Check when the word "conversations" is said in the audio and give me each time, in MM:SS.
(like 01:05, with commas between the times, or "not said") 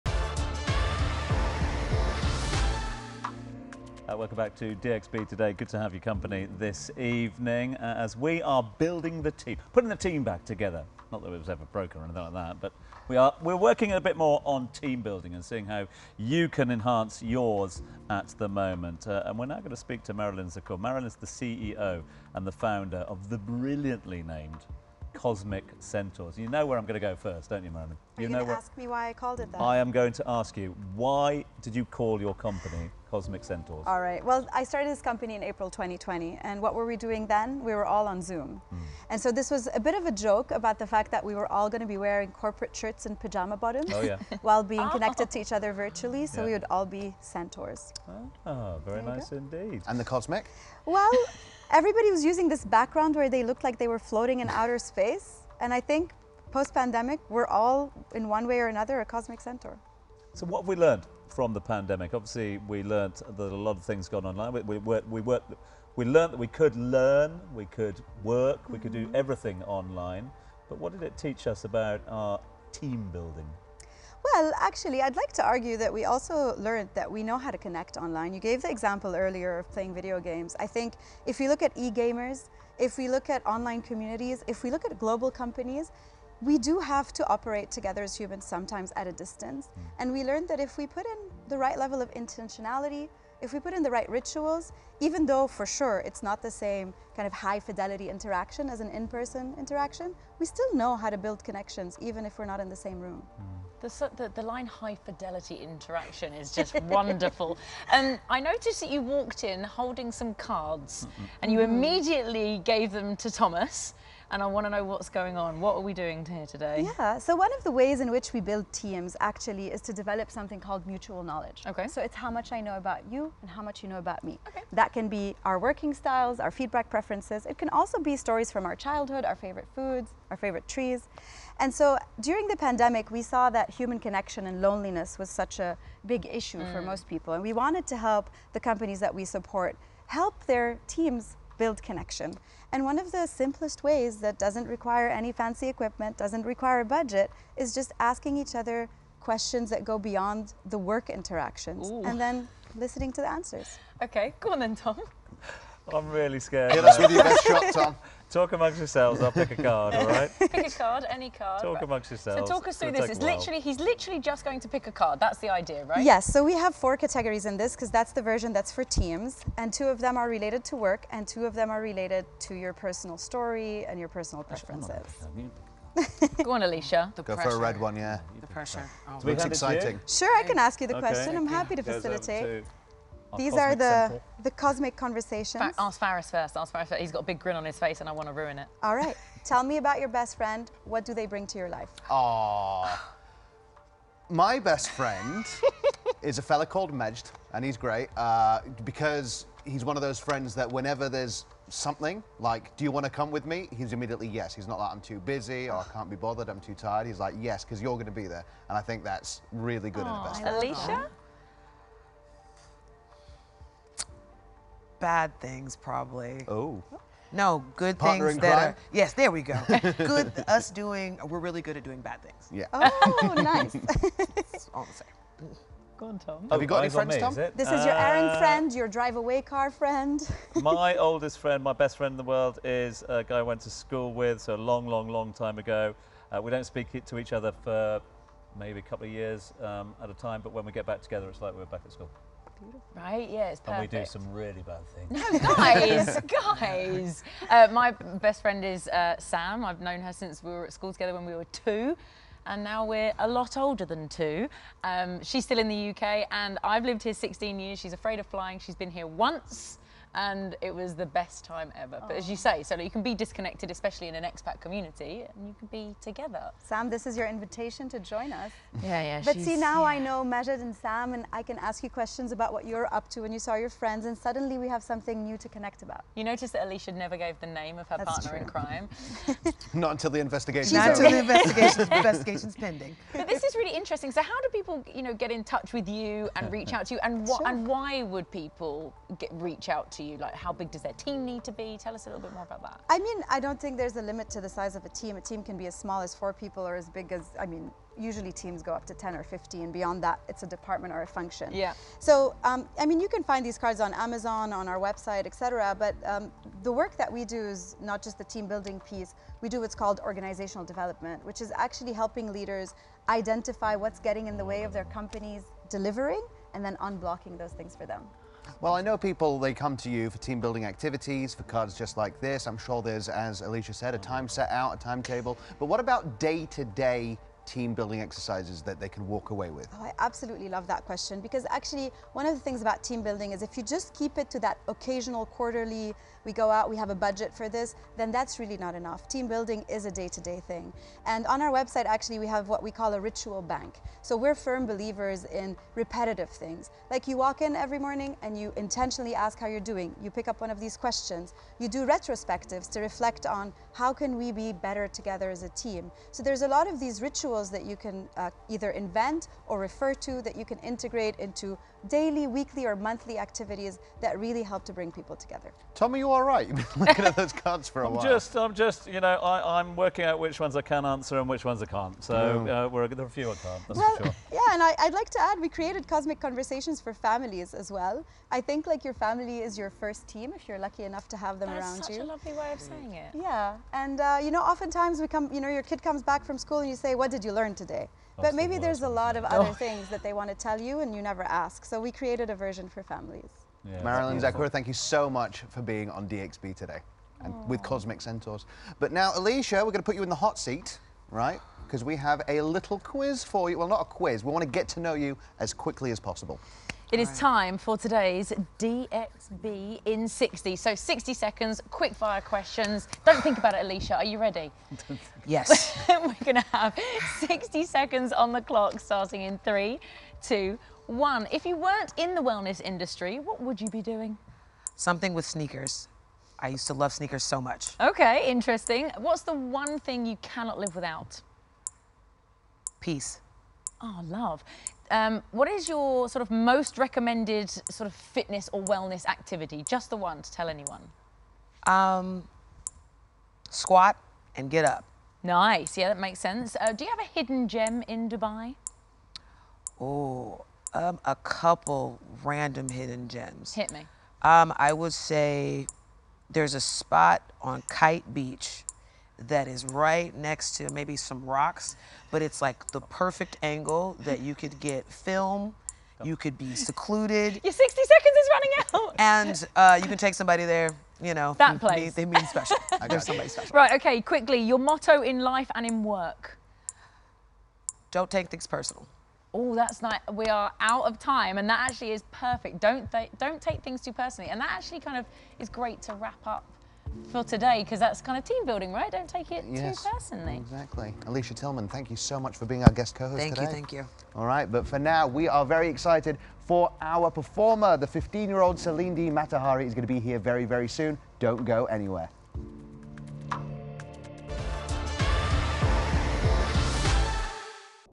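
03:04, 06:16.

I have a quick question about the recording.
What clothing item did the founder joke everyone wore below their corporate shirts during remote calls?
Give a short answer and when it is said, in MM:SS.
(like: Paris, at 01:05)
pajama bottoms, at 00:43.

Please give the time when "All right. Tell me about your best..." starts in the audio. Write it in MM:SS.
03:08.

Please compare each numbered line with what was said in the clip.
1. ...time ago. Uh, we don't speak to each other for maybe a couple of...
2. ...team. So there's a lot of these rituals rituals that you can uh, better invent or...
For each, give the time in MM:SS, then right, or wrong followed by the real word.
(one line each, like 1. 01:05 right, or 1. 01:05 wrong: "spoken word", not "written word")
1. 03:55 right
2. 05:55 wrong: "either", not "better".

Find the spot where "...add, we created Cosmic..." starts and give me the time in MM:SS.
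06:15.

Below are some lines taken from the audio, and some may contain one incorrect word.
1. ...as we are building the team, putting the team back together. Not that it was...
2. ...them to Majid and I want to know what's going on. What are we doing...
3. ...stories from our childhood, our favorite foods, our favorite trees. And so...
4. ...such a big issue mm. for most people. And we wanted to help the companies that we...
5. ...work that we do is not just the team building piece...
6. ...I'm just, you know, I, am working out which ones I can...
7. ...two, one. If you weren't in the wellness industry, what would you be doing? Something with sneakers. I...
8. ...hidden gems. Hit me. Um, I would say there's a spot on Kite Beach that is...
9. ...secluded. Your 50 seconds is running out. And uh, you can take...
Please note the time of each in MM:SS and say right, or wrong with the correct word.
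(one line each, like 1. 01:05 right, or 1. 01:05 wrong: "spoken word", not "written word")
1. 00:07 right
2. 01:52 wrong: "Thomas", not "Majid"
3. 02:08 right
4. 02:15 right
5. 05:06 right
6. 06:08 right
7. 07:00 right
8. 07:32 right
9. 07:46 wrong: "60", not "50".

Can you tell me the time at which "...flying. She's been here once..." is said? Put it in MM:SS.
04:18.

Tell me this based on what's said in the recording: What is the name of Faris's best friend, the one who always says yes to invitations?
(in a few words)
Majd.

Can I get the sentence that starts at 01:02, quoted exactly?
Obviously, we learned that a lot of things gone online.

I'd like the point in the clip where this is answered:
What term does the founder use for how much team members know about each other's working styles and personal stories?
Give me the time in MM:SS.
02:00.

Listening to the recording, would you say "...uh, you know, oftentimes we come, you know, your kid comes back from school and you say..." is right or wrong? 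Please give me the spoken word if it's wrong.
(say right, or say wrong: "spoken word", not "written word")
right.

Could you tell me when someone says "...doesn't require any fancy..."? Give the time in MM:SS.
02:24.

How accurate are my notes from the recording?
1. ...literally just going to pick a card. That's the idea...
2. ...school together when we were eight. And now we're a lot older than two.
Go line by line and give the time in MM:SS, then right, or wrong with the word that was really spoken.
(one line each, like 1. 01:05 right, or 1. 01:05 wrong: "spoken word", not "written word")
1. 02:43 right
2. 04:10 wrong: "two", not "eight".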